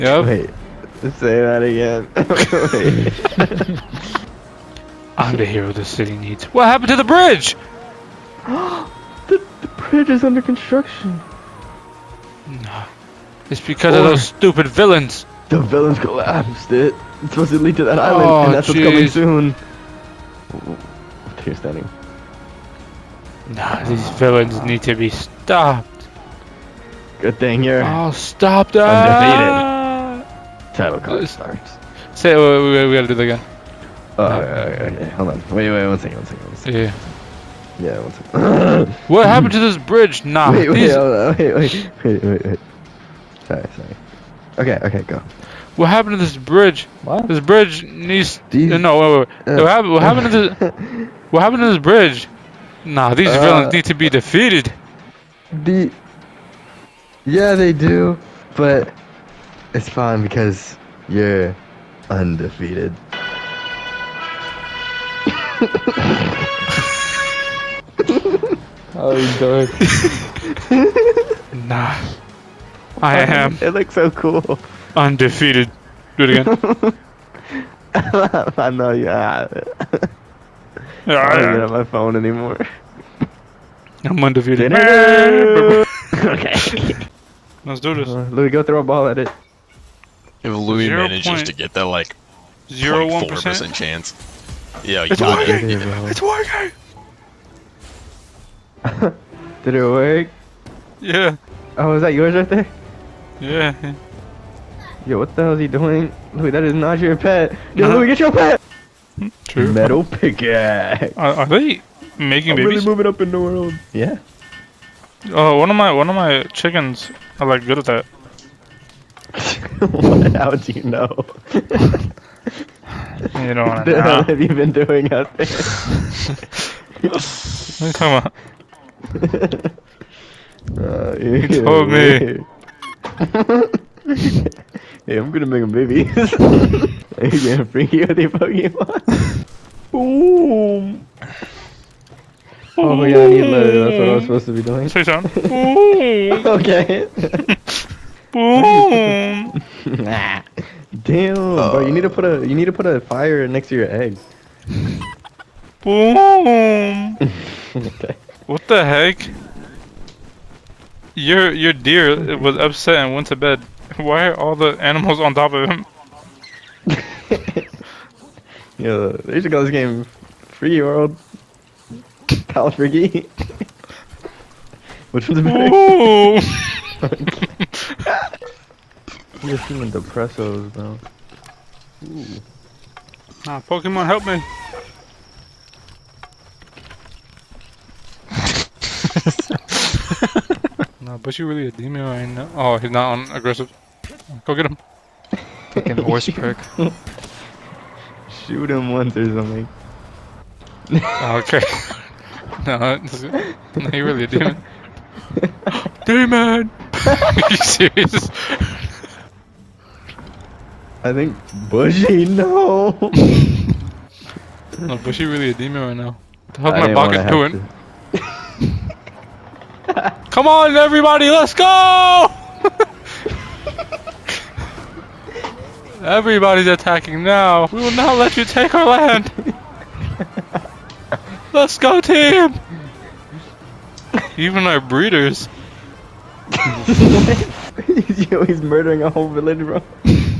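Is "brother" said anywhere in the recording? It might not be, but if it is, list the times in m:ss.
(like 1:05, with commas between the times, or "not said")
not said.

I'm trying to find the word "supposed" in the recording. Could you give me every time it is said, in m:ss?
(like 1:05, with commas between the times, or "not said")
0:17, 2:24.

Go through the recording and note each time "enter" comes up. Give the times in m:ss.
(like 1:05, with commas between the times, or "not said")
not said.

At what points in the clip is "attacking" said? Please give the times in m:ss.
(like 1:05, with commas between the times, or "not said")
3:46.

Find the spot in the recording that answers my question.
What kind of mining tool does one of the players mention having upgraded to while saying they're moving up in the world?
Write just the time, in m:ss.
1:49.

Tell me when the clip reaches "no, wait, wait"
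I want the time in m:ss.
0:48.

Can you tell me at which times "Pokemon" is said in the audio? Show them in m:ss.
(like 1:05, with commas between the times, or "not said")
2:18, 3:03.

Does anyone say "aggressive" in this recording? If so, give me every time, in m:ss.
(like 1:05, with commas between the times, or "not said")
3:13.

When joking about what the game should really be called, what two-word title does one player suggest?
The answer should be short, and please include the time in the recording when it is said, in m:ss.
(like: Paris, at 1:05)
Free World, at 2:50.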